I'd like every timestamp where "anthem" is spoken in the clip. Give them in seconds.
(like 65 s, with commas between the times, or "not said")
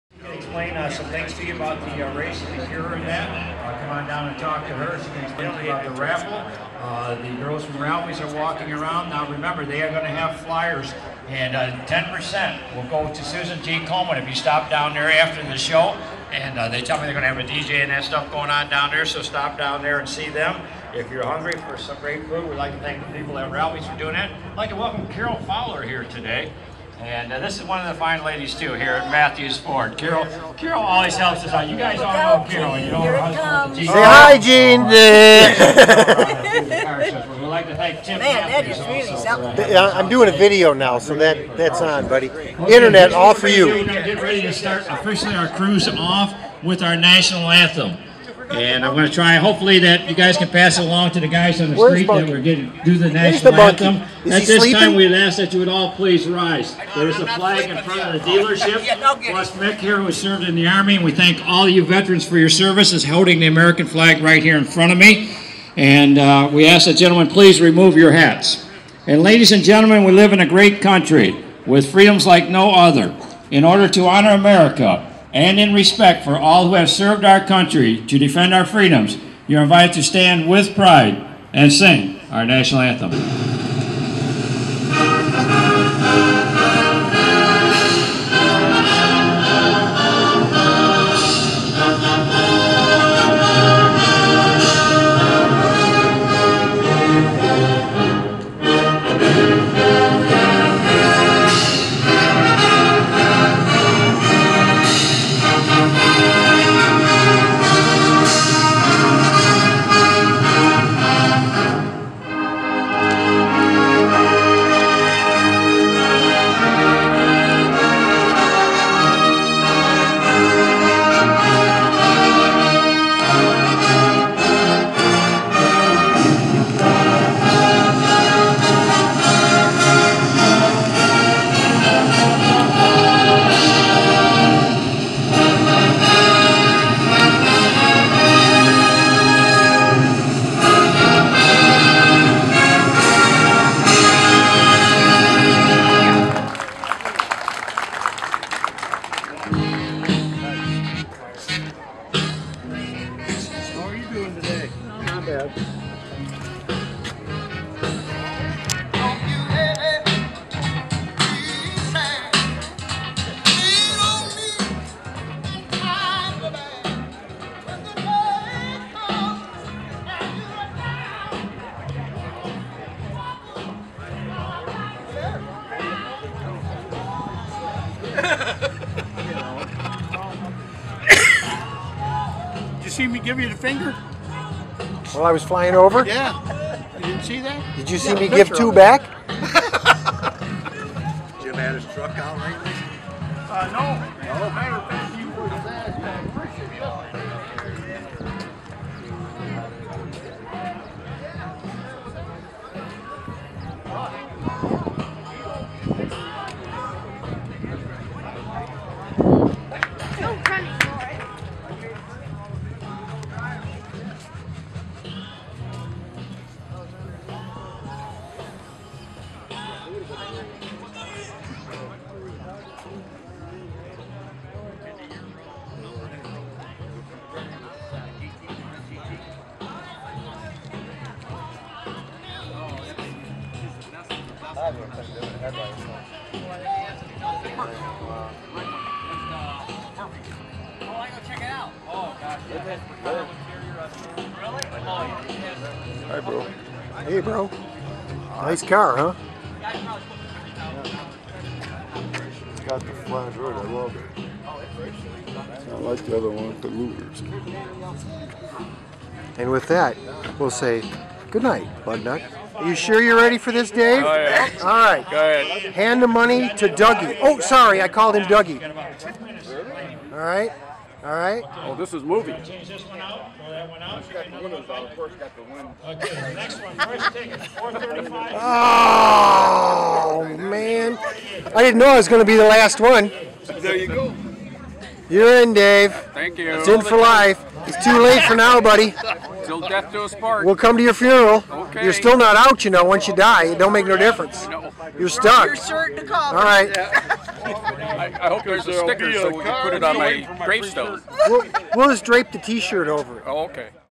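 47 s, 53 s, 82 s.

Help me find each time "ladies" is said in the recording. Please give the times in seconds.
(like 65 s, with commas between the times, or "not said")
28 s, 69 s.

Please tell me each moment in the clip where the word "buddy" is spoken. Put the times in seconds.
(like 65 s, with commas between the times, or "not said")
42 s, 288 s.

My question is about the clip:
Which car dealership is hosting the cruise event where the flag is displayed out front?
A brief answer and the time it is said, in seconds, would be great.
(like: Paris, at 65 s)
Mathews Ford, at 29 s.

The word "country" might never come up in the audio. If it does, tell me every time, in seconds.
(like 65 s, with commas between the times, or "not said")
70 s, 77 s.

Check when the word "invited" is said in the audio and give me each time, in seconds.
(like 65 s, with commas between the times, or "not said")
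79 s.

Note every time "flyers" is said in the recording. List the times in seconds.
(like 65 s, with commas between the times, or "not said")
10 s.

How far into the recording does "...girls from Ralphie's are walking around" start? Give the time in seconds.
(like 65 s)
7 s.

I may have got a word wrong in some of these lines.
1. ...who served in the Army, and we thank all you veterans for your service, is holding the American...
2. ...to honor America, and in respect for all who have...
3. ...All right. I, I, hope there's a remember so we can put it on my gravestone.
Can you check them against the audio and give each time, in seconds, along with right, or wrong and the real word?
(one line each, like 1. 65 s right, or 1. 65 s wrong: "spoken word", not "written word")
1. 59 s right
2. 73 s right
3. 296 s wrong: "sticker", not "remember".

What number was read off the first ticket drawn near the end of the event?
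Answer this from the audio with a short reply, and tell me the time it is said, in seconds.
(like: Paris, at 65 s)
435, at 277 s.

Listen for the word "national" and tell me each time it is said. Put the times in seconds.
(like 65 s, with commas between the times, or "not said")
46 s, 53 s, 82 s.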